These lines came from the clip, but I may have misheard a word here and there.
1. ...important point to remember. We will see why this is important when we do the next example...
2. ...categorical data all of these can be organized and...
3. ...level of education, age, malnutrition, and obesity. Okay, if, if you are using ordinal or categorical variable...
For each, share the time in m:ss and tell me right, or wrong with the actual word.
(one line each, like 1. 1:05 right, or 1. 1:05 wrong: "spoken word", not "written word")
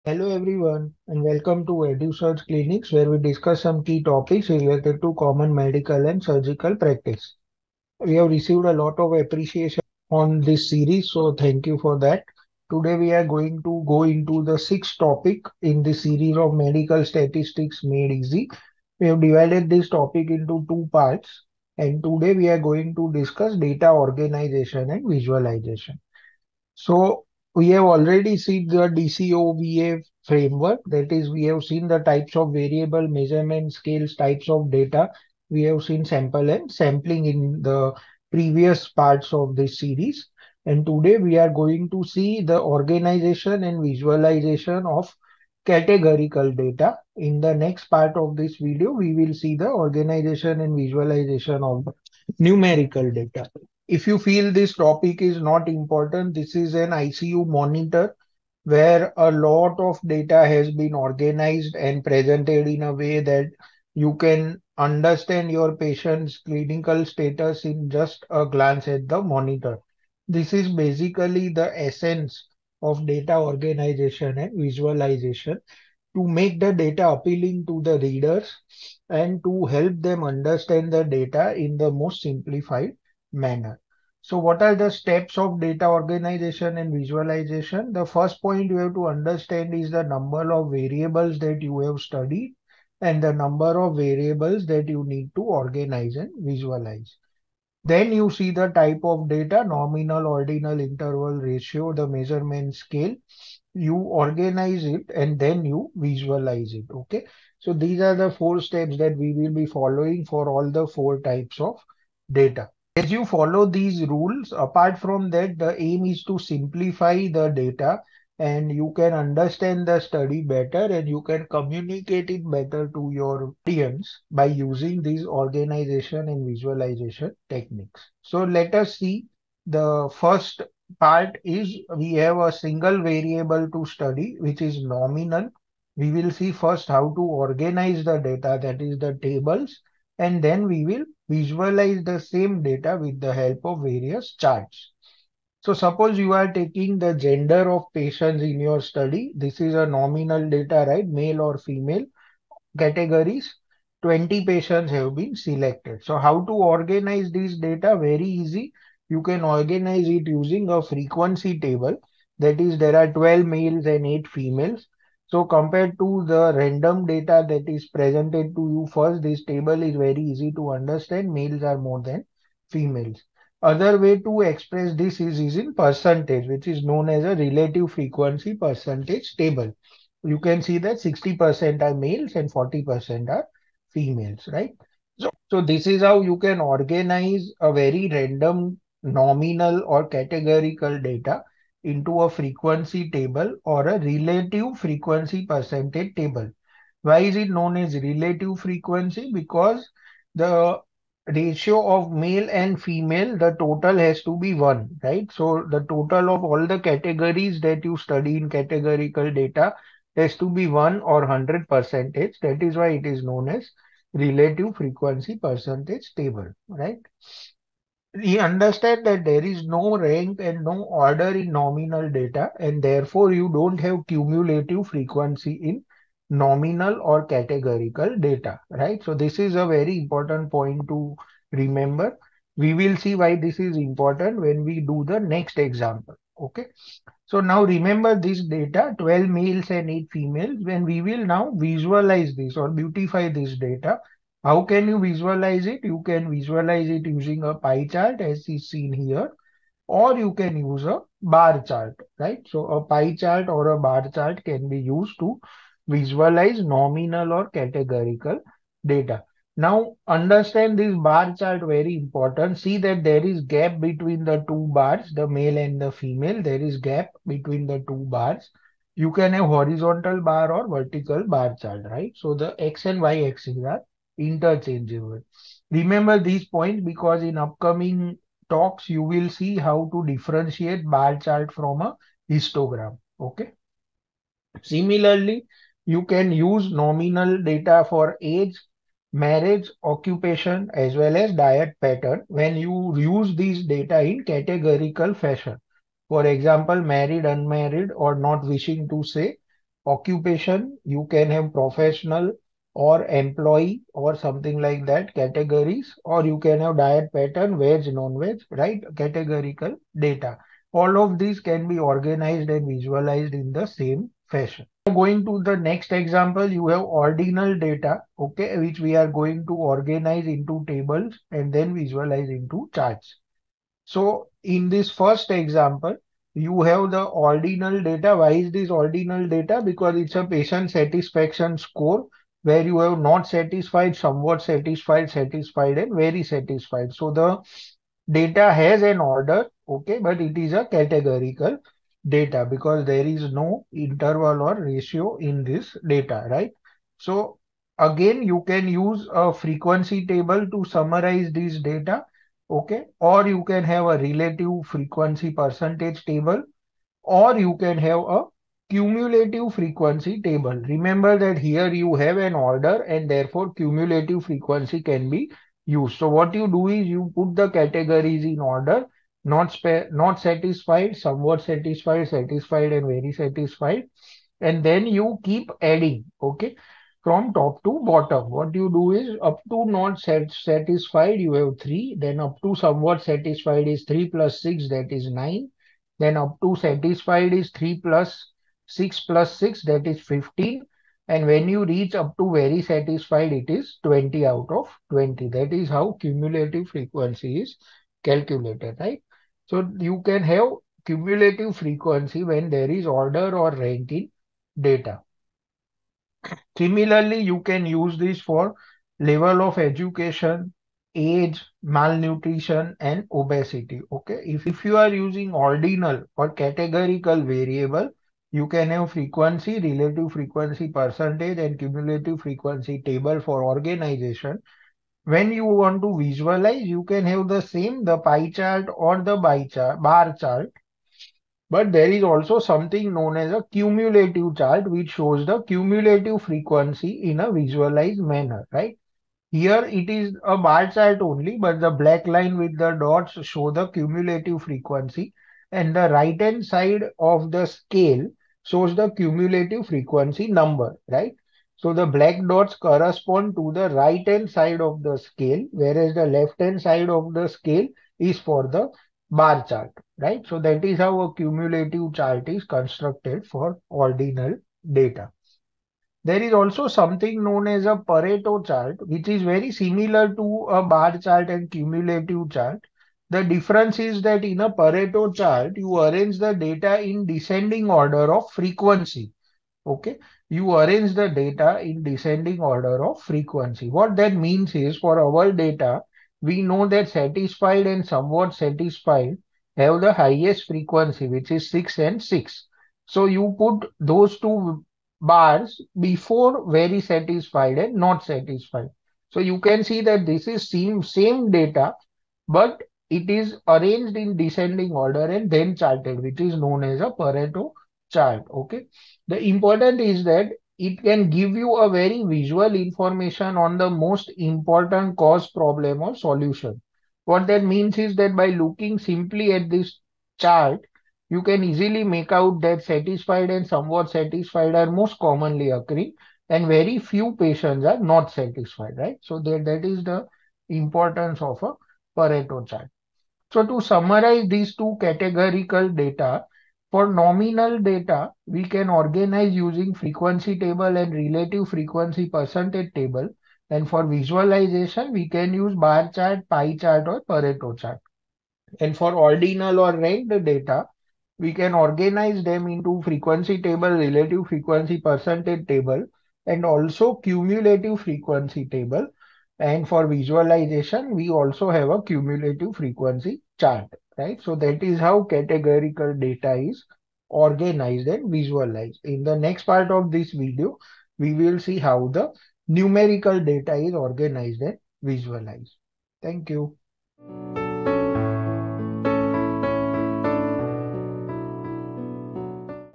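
1. 3:49 right
2. 5:08 right
3. 6:48 right.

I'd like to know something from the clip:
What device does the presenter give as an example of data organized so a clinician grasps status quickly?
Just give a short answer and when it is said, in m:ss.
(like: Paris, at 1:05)
ICU monitor, at 0:56.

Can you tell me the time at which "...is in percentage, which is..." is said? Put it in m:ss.
2:55.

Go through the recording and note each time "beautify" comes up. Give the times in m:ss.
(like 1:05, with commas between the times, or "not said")
4:02.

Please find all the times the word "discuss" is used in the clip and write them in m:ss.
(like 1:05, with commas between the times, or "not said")
0:03, 0:23.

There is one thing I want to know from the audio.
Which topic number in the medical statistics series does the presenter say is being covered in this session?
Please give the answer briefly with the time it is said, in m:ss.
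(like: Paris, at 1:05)
sixth, at 0:14.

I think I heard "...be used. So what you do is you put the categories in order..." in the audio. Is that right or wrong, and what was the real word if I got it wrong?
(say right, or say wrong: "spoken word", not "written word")
right.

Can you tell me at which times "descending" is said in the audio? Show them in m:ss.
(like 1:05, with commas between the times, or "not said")
7:57, 8:01, 8:24.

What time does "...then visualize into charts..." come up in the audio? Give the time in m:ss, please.
5:21.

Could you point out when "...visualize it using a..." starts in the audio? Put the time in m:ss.
4:06.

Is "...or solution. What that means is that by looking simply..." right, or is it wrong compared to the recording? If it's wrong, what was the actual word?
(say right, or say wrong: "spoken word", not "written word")
right.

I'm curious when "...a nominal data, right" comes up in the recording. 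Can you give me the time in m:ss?
2:29.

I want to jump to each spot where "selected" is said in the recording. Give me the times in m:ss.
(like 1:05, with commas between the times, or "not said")
2:35.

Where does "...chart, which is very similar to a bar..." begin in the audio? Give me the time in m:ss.
7:48.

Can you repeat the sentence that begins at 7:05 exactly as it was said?
When you want to visualize, you can have the same, the pie chart or the bar chart.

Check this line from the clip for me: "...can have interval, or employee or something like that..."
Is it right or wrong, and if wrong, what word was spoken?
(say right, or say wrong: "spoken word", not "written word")
wrong: "professional", not "interval".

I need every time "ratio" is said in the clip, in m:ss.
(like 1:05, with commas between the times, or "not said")
1:41, 3:21, 5:44.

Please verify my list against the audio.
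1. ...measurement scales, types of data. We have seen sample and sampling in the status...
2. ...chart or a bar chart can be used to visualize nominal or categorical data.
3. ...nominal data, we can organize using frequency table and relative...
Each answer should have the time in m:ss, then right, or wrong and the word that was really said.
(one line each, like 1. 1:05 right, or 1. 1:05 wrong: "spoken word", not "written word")
1. 0:33 wrong: "previous", not "status"
2. 4:13 right
3. 8:56 right.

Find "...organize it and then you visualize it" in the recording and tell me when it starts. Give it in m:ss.
1:43.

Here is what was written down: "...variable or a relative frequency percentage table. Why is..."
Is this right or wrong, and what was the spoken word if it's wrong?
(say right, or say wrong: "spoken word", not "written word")
wrong: "table", not "variable".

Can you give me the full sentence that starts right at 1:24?
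So what are the steps of data organization and visualization?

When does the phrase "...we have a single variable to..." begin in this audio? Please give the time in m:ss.
2:11.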